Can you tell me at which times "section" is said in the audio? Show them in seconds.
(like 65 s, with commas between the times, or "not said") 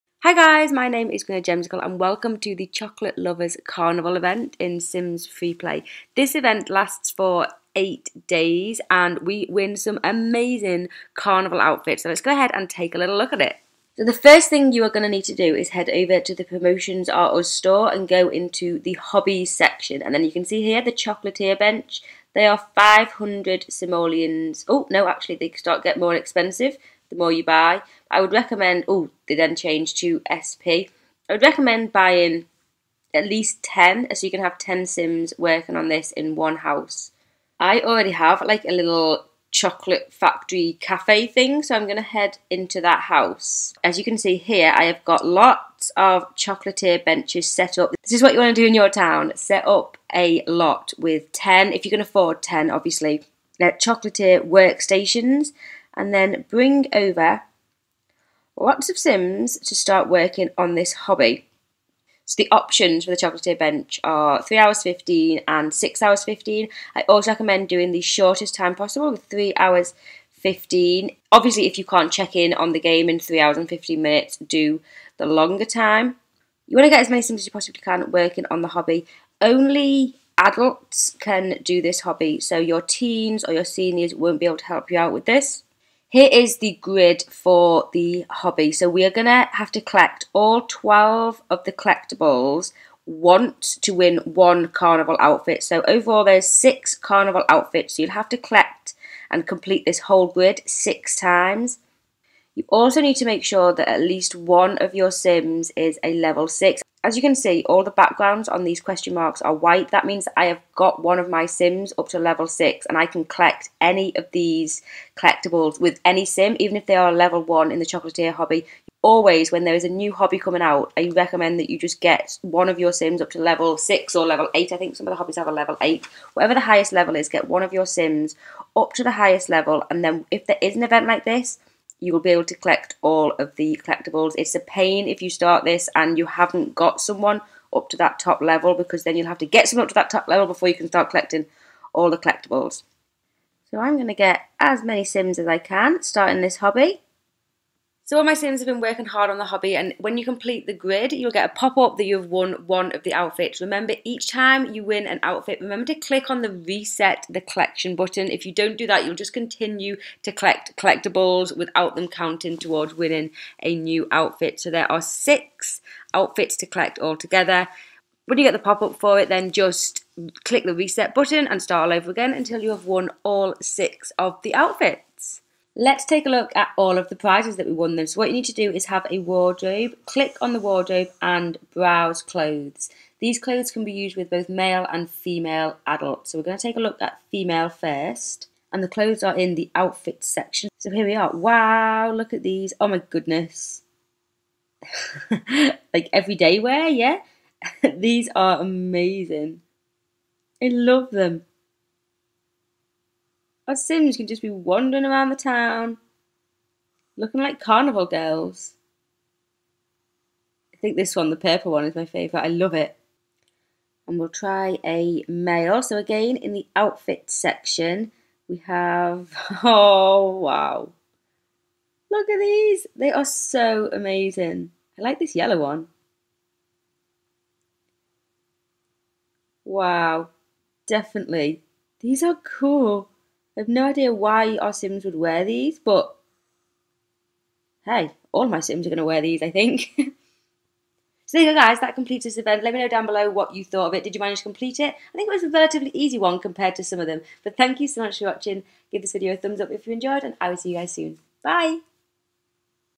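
19 s, 190 s, 217 s.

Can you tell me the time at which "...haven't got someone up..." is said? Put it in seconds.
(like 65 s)
136 s.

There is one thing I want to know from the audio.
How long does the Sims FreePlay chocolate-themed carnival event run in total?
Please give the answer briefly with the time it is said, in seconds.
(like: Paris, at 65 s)
8 days, at 7 s.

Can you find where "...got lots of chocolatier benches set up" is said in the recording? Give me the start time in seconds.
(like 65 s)
45 s.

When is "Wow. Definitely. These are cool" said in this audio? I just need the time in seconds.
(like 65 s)
229 s.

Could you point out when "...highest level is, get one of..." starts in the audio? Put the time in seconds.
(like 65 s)
126 s.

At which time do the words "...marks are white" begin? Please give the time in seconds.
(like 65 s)
109 s.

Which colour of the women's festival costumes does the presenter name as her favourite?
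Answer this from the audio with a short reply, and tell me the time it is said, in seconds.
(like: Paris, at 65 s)
Purple, at 211 s.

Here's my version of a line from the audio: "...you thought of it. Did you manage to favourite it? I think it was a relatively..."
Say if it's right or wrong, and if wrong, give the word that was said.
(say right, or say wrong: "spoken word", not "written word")
wrong: "complete", not "favourite".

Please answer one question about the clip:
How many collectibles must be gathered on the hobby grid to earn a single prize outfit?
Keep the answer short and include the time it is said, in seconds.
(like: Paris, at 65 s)
12, at 90 s.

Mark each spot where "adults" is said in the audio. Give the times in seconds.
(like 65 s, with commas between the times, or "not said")
80 s, 185 s.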